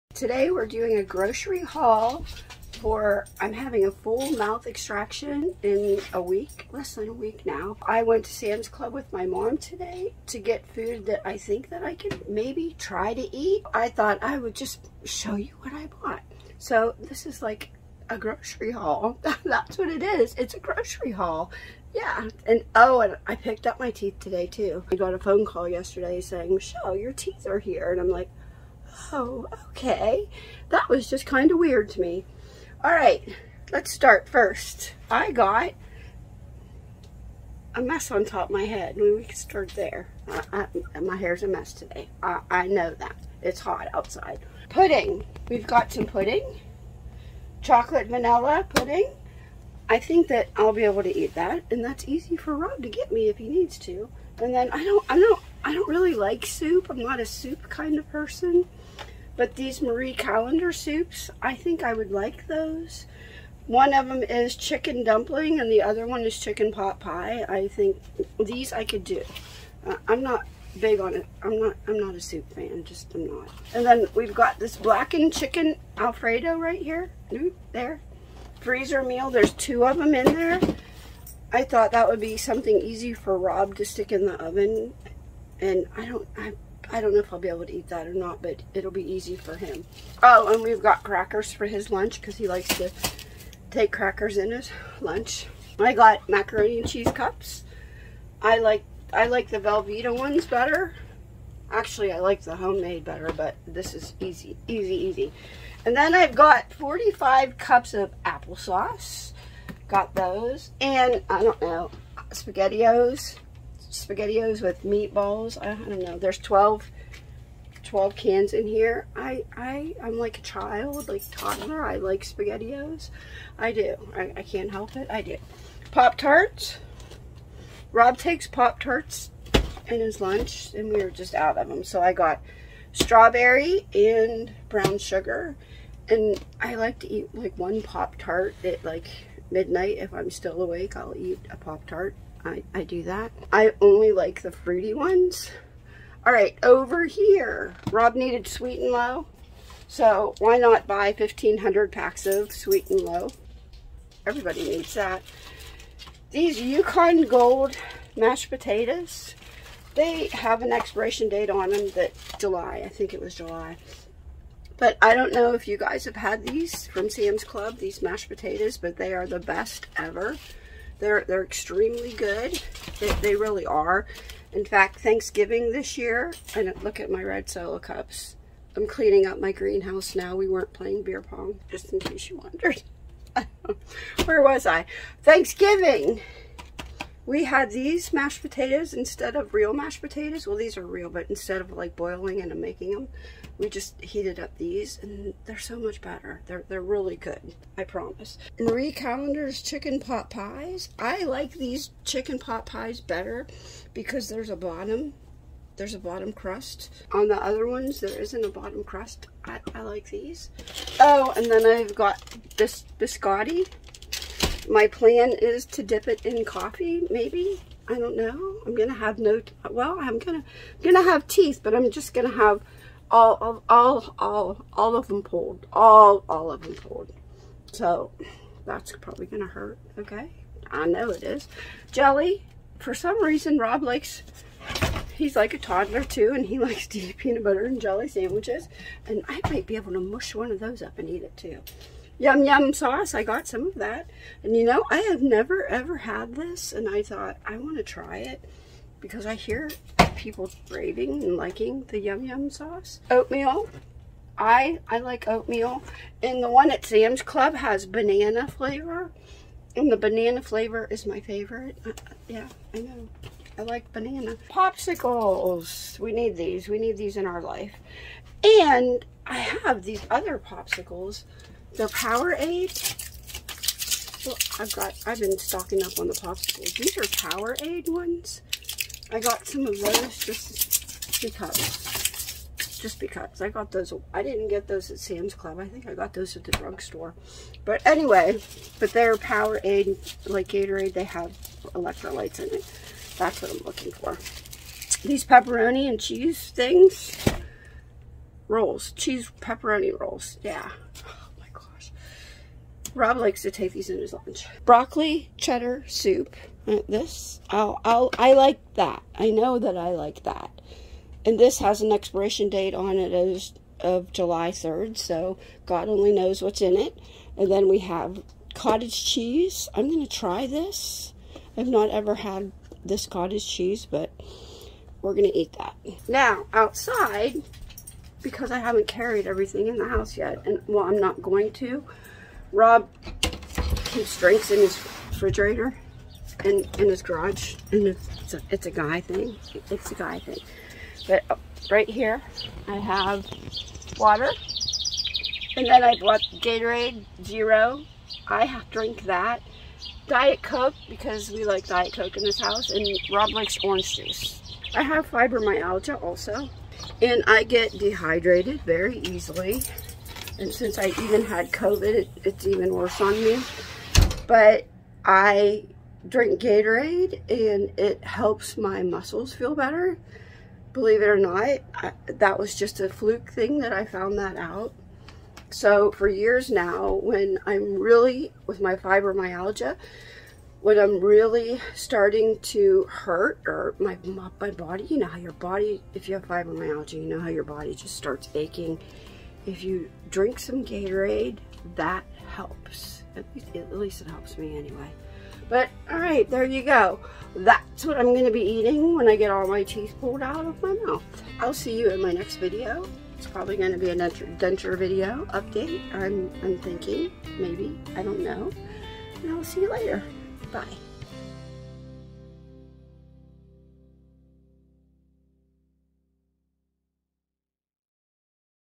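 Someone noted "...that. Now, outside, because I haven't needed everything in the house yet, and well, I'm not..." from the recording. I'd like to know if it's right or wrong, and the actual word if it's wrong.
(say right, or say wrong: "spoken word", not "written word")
wrong: "carried", not "needed".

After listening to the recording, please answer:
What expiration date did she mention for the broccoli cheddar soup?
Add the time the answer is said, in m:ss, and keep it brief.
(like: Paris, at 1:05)
July 3rd, at 5:14.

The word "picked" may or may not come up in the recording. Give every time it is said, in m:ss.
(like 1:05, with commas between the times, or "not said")
0:23.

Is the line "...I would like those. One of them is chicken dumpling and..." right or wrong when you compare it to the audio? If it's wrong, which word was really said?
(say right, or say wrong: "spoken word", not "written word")
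right.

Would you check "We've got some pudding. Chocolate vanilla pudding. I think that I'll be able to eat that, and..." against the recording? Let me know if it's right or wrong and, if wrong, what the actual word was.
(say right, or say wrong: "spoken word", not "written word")
right.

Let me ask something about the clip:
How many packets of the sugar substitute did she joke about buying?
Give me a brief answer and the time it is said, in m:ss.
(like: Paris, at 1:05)
1,500, at 2:31.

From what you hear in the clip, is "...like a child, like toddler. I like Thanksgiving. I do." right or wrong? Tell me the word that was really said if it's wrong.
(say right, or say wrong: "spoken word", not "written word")
wrong: "SpaghettiOs", not "Thanksgiving".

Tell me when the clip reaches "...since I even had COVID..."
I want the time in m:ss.
6:00.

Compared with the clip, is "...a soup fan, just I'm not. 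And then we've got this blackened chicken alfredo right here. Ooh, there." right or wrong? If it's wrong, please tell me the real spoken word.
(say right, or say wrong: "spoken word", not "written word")
right.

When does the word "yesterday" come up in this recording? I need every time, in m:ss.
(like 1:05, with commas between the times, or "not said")
0:25.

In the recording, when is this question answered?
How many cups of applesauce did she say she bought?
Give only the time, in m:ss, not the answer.
1:46.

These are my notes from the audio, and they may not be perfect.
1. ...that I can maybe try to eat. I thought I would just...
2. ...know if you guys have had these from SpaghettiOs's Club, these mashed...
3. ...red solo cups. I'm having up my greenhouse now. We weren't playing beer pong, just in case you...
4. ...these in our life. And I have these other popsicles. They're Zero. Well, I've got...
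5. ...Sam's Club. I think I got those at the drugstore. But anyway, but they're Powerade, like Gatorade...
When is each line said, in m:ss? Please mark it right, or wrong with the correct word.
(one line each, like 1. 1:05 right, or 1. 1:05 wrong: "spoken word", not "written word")
1. 0:11 right
2. 2:45 wrong: "Sam", not "SpaghettiOs"
3. 2:57 wrong: "cleaning", not "having"
4. 4:26 wrong: "Powerade", not "Zero"
5. 4:44 right.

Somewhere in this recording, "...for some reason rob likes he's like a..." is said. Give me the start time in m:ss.
3:52.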